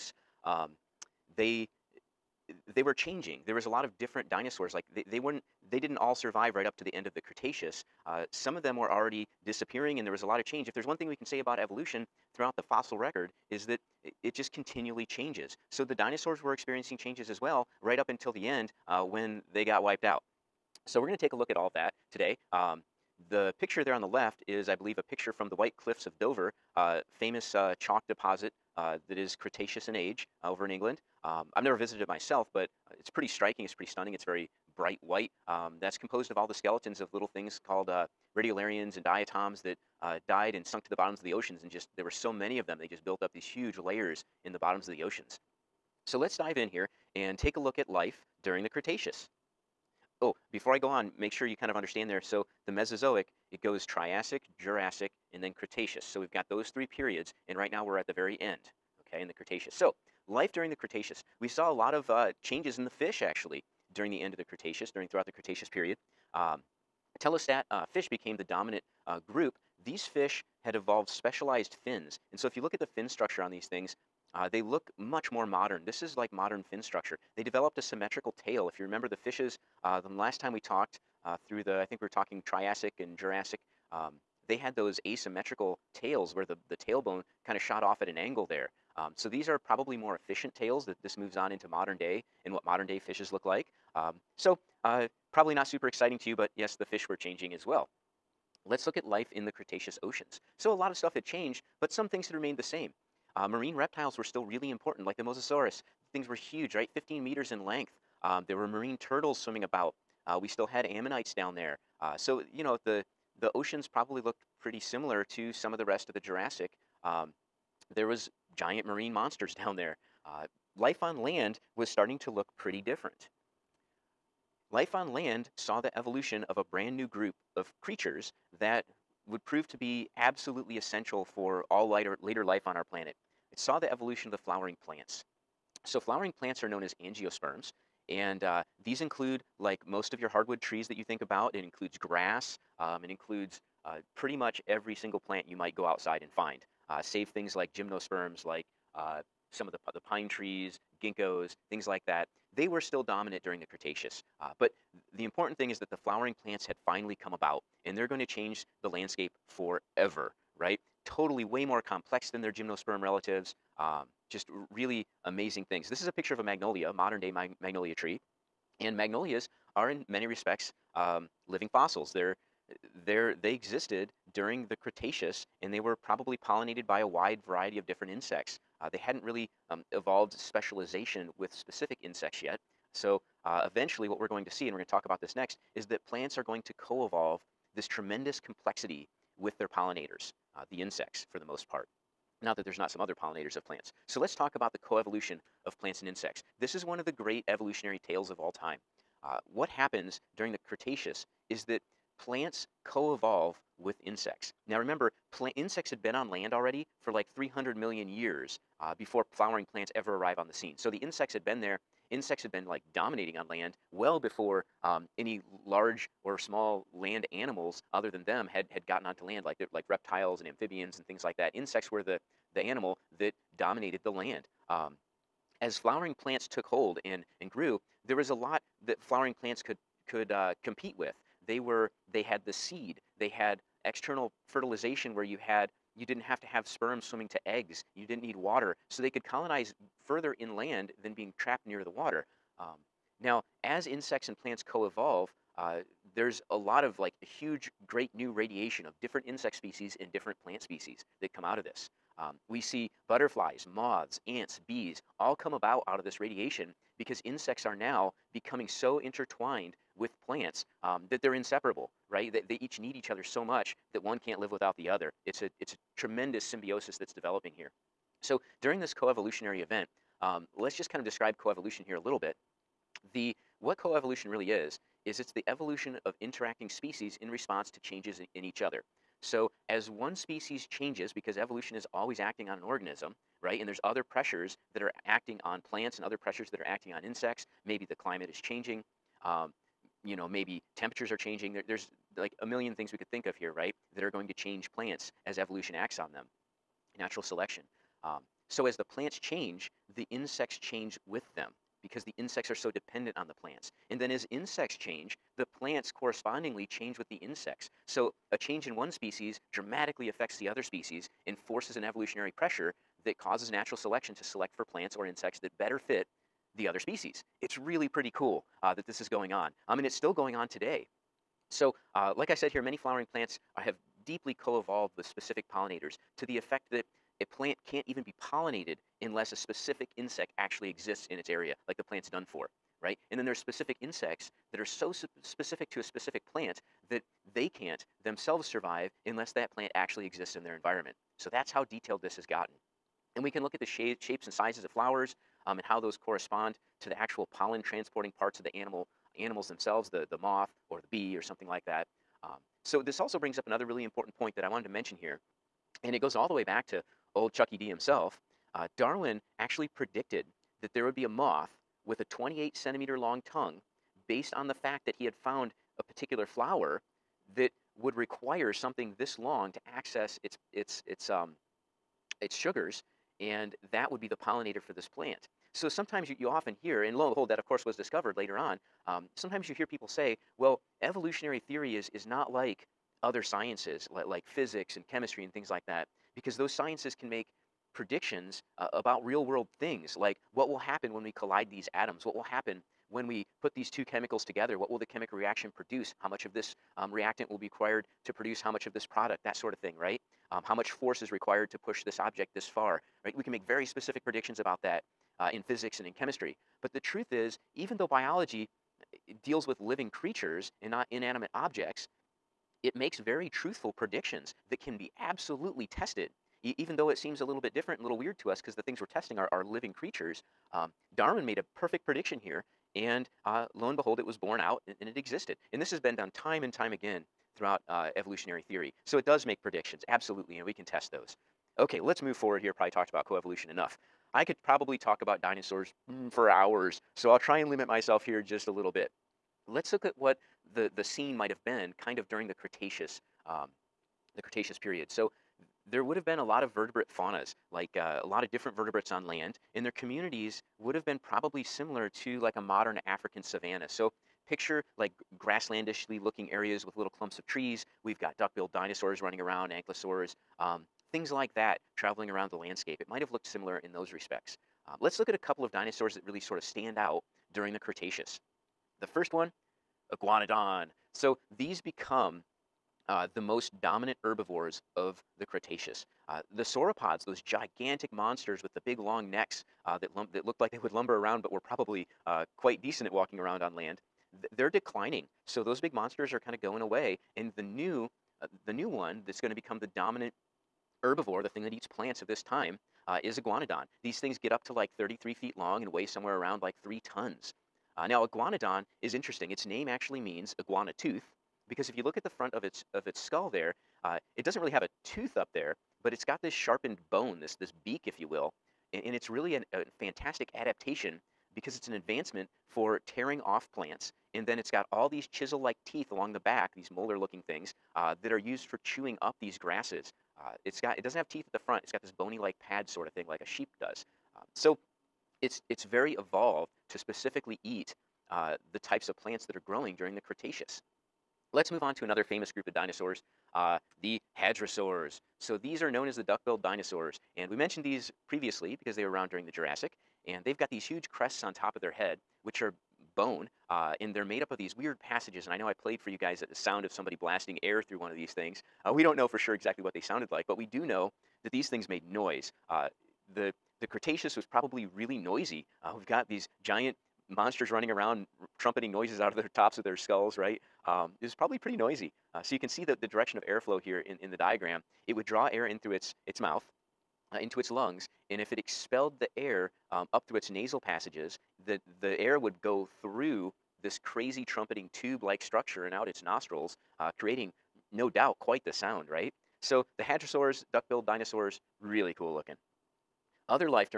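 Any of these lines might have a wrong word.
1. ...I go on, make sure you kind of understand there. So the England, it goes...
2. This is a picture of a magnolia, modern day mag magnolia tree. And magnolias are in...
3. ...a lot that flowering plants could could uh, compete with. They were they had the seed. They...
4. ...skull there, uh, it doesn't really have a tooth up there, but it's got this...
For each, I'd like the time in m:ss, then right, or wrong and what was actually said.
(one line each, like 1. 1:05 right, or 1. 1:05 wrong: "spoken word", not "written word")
1. 0:50 wrong: "Mesozoic", not "England"
2. 2:45 right
3. 3:48 right
4. 8:22 right.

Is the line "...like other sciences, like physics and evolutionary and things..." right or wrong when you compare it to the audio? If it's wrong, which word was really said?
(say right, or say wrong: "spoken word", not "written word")
wrong: "chemistry", not "evolutionary".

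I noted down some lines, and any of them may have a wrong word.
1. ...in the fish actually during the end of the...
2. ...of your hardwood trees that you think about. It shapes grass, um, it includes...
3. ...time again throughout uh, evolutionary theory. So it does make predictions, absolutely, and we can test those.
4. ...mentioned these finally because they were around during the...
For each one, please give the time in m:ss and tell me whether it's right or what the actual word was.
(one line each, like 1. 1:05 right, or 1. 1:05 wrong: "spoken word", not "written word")
1. 1:02 right
2. 2:20 wrong: "includes", not "shapes"
3. 7:06 right
4. 8:57 wrong: "previously", not "finally".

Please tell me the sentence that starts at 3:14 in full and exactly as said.
So let's talk about the coevolution of plants and insects.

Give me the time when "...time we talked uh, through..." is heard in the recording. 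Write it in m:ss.
1:20.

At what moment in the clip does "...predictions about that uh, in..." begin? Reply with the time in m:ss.
6:44.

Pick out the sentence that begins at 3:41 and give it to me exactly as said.
Insects were the, the animal that dominated the land.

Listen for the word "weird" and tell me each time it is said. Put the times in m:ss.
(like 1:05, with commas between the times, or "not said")
6:57, 9:04.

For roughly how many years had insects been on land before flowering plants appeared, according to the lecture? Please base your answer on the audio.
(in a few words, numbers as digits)
300 million years.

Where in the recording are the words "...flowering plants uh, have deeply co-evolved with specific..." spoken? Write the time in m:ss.
5:22.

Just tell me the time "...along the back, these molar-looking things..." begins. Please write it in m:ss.
8:35.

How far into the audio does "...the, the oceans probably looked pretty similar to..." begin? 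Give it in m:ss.
1:52.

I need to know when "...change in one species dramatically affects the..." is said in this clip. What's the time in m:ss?
5:08.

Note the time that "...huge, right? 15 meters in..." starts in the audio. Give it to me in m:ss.
1:46.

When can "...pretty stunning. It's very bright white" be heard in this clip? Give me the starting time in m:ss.
0:33.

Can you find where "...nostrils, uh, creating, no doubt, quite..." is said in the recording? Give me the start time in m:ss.
9:36.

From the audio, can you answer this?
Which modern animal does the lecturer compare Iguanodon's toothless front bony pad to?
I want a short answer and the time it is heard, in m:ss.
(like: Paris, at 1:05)
Sheep, at 8:43.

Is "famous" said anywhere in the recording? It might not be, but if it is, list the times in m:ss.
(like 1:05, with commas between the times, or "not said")
0:27, 8:52.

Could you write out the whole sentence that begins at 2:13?
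It saw the evolution of the flowering plants.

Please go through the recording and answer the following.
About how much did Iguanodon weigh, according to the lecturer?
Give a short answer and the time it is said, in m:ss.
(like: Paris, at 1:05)
3 tons, at 8:16.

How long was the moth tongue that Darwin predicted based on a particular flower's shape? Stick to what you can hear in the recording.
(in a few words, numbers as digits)
28 centimeters.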